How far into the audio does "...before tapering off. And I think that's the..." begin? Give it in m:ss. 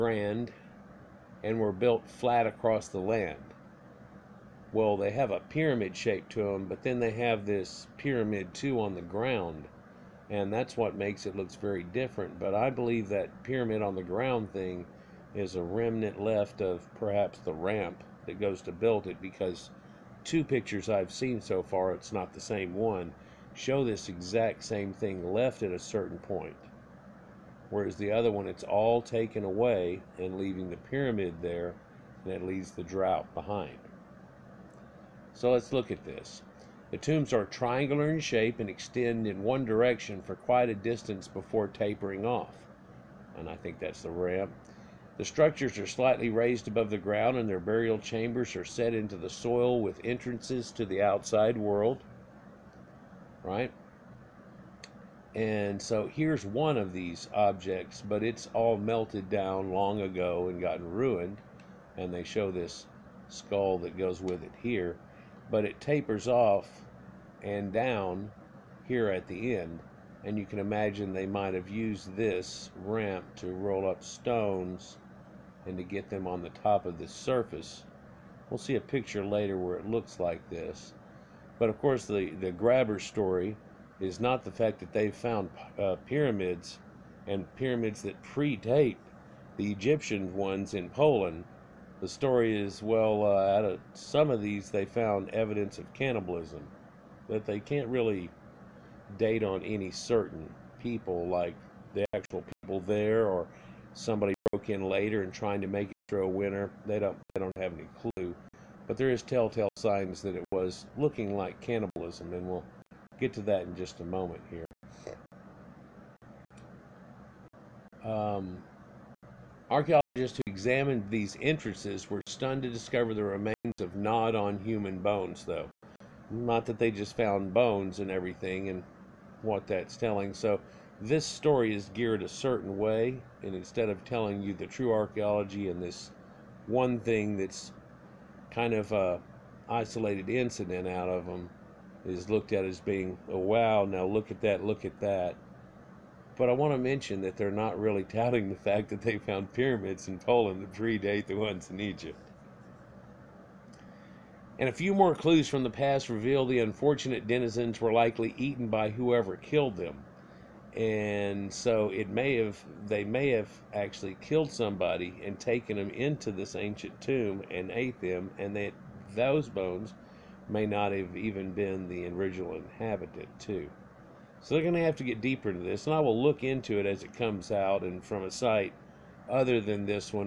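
0:41.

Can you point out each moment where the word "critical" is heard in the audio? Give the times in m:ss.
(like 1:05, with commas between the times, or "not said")
not said.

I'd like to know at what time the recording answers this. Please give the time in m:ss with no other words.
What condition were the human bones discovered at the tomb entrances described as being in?
2:03.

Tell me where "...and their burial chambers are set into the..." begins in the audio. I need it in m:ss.
0:47.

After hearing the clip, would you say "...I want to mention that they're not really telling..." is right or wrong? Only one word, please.
wrong.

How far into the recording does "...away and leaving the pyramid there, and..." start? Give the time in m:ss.
0:29.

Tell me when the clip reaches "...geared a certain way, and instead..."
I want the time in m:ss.
2:11.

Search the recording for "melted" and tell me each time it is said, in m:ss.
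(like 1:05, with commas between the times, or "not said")
0:58.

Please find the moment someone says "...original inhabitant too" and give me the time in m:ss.
2:52.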